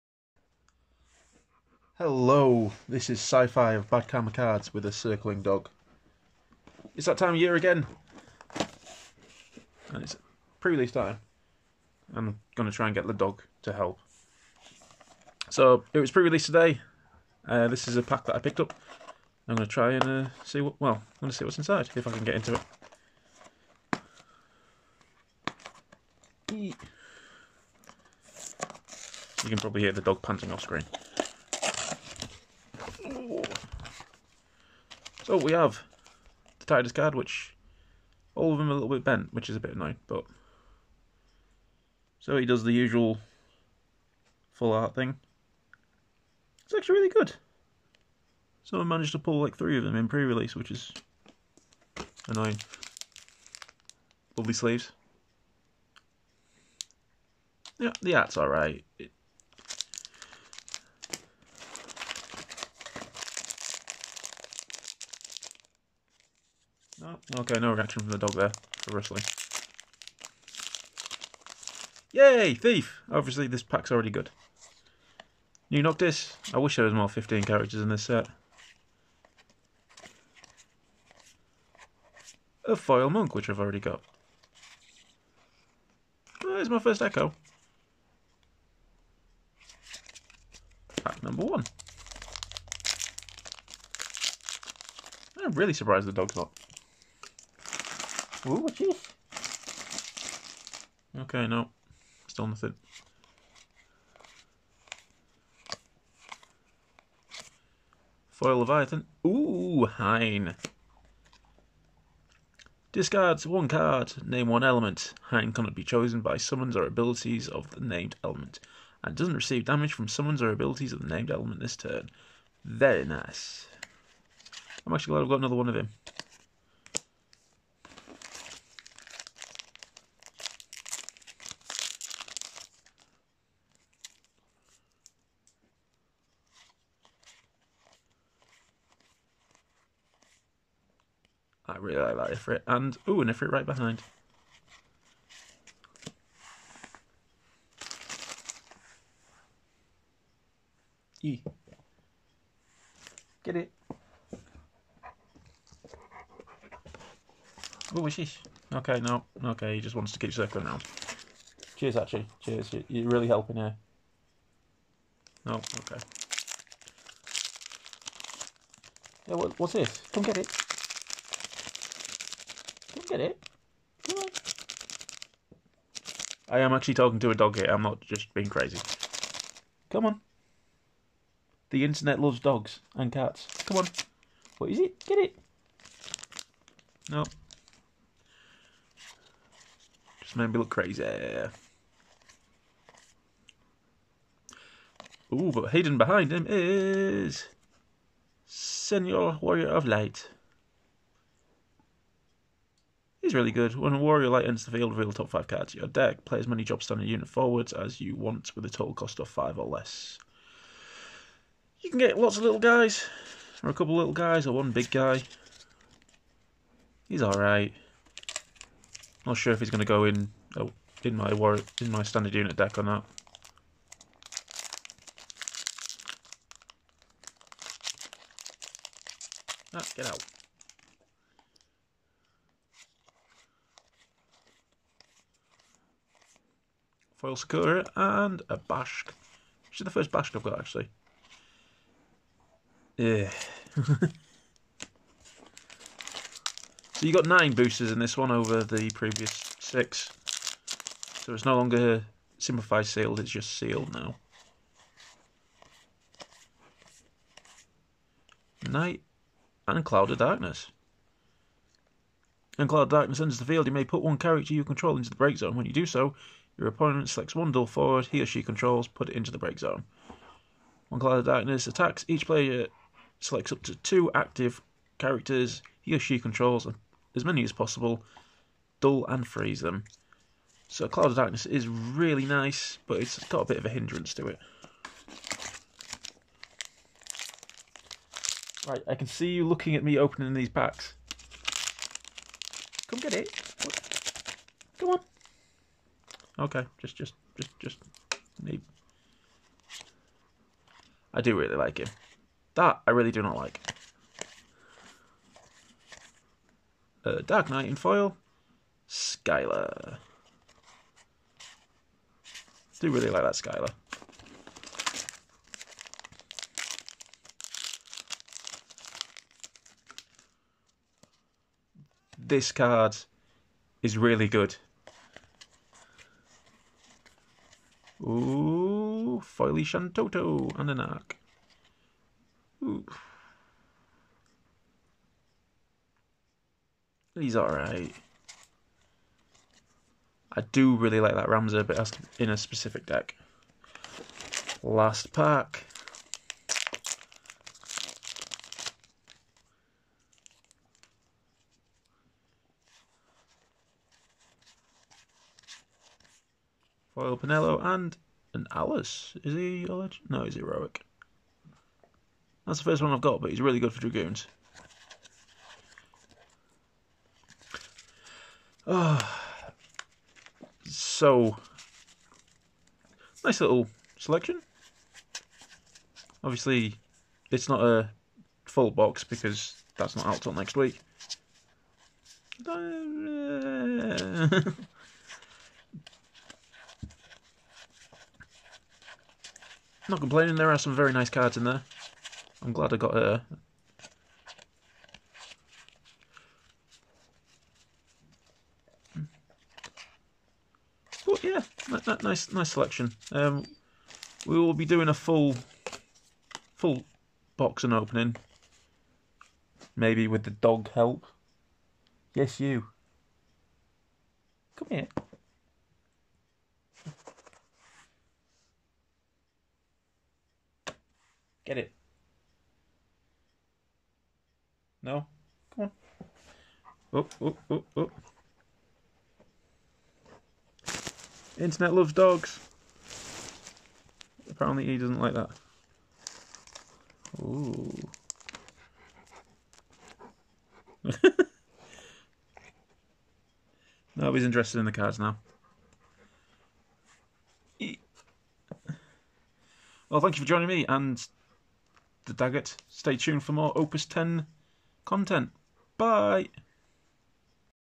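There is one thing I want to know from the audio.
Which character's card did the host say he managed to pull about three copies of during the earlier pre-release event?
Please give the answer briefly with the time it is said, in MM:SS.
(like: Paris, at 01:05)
Titus, at 00:36.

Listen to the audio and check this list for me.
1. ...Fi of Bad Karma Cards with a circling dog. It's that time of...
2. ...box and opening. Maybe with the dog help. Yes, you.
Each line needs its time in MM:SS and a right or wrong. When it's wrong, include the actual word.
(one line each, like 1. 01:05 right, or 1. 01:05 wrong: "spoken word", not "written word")
1. 00:03 right
2. 06:47 right.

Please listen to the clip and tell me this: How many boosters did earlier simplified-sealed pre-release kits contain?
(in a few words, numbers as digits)
6.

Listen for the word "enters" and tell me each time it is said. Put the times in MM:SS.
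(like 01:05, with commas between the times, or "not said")
03:24, 04:23.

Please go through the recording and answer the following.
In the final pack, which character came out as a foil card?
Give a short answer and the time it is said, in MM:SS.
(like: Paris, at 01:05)
Penelo, at 05:57.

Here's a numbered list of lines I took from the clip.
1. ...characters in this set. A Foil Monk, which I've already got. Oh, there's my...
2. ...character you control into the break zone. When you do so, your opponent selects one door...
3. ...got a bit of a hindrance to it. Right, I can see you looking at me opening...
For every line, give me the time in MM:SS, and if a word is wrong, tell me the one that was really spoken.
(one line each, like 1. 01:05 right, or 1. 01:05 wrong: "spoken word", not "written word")
1. 01:17 right
2. 04:24 right
3. 04:43 right.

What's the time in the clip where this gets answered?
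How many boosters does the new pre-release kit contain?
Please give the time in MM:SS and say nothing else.
04:07.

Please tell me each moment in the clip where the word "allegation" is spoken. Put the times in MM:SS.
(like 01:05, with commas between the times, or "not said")
not said.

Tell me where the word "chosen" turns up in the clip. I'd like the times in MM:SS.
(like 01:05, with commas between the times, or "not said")
01:55.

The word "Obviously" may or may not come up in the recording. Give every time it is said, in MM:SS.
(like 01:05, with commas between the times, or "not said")
01:13, 06:16.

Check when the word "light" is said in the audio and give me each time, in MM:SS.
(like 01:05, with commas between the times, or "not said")
03:19, 03:24.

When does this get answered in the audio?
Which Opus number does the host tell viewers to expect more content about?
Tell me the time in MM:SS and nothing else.
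07:33.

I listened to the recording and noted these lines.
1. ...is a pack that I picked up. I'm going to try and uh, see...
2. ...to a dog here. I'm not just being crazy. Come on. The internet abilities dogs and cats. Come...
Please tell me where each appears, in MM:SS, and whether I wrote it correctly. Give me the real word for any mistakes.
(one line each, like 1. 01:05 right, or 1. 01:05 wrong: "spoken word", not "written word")
1. 00:17 right
2. 02:57 wrong: "loves", not "abilities".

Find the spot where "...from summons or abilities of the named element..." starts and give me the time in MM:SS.
01:59.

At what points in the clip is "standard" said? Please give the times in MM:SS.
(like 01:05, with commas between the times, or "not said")
03:26, 03:42.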